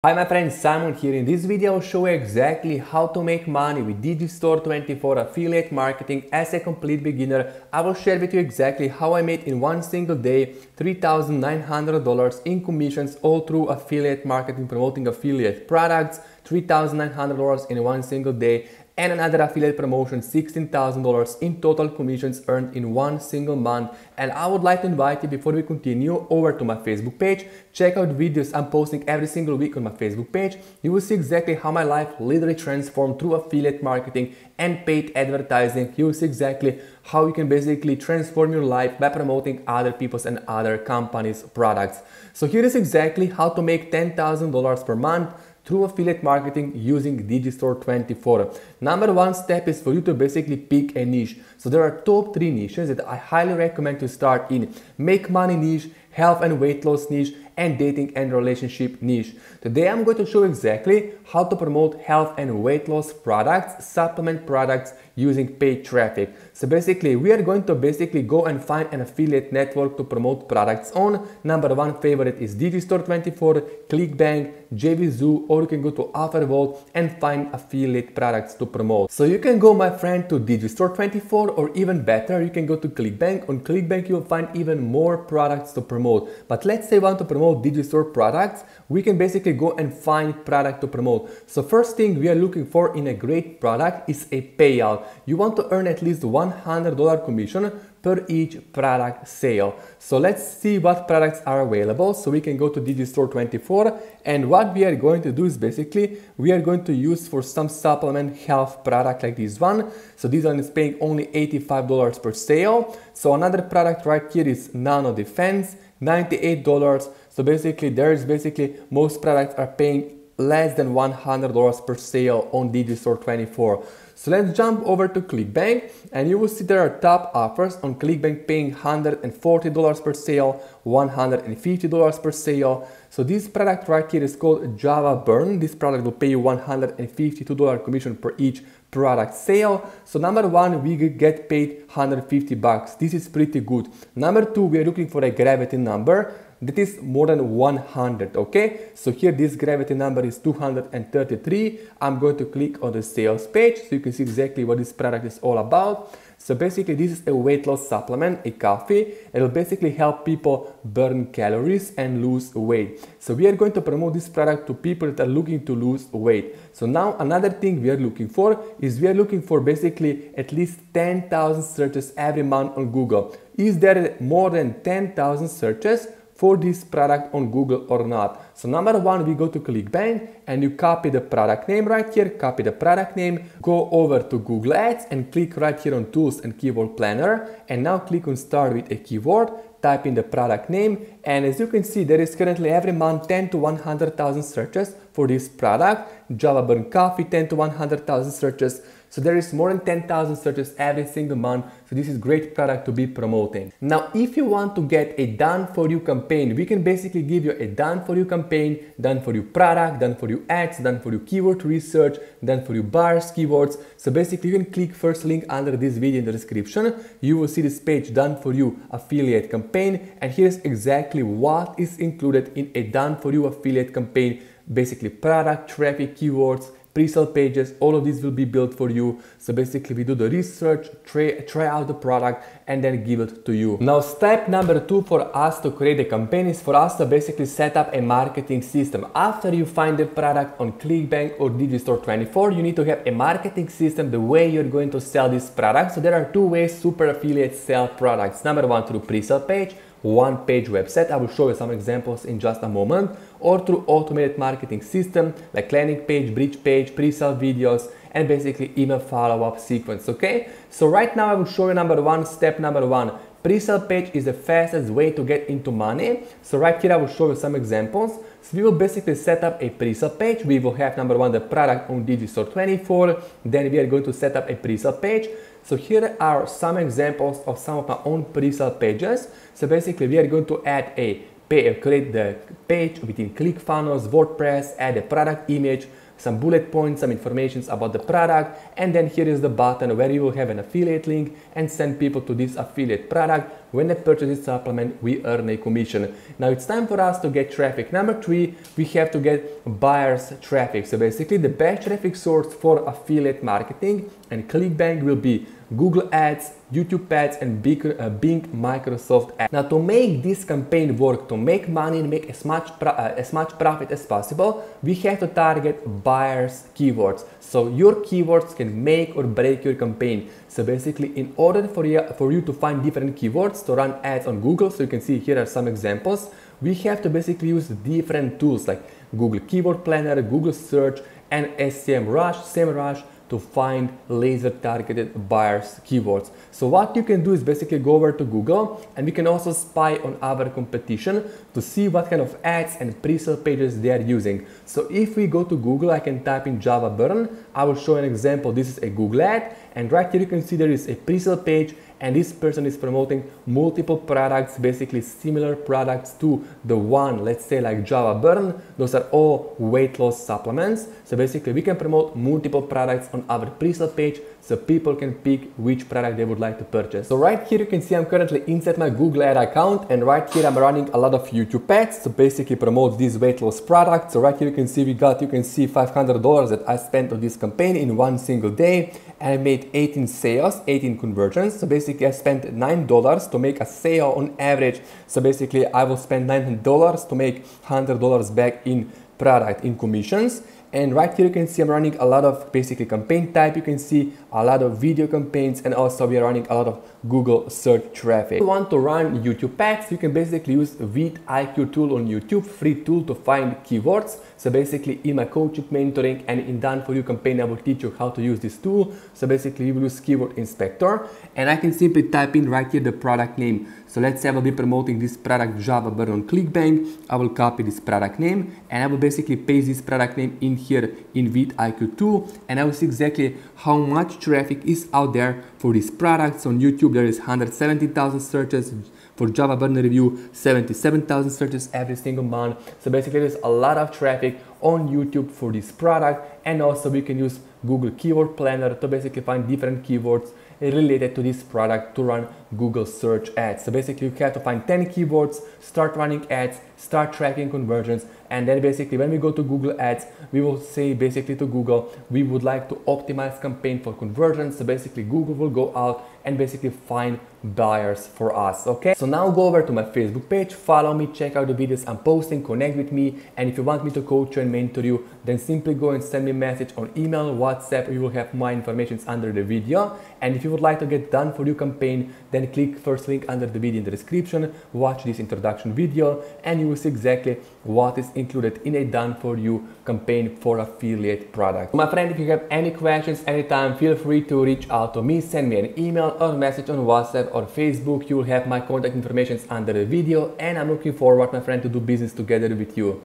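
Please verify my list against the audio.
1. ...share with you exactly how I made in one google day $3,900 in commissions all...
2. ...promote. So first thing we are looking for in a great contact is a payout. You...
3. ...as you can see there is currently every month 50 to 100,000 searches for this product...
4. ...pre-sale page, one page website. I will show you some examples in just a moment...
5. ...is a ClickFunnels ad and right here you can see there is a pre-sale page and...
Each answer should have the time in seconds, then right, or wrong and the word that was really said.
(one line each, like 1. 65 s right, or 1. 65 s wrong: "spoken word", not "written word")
1. 7 s wrong: "single", not "google"
2. 90 s wrong: "product", not "contact"
3. 191 s wrong: "10", not "50"
4. 249 s right
5. 348 s wrong: "Google", not "ClickFunnels".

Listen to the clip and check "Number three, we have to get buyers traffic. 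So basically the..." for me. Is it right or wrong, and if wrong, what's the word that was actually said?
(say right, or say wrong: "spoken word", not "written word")
right.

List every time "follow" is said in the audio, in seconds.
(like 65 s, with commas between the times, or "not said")
258 s, 460 s.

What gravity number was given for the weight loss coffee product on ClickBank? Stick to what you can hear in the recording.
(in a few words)
233.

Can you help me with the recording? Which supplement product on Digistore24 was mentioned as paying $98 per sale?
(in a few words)
Nano Defense.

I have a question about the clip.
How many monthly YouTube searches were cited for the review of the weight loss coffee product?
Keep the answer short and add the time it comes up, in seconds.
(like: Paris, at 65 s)
77,000, at 430 s.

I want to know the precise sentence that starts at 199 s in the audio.
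So there is more than 10,000 searches every single month.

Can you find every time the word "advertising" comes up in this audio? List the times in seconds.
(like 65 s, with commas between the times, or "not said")
35 s.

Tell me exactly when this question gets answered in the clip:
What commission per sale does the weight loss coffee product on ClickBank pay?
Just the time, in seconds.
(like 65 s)
136 s.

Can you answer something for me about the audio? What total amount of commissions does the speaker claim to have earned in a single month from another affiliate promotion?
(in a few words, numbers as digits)
$16,000.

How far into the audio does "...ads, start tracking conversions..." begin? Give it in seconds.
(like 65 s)
446 s.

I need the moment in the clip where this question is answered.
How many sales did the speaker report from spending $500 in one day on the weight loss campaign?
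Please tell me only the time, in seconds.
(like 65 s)
379 s.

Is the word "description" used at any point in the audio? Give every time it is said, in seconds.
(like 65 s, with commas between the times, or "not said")
216 s, 473 s.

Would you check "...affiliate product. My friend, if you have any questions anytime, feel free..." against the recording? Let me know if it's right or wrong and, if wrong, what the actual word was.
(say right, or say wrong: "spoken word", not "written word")
right.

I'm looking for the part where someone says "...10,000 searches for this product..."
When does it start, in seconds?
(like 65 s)
174 s.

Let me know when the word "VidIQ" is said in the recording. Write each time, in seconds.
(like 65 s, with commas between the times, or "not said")
400 s, 421 s.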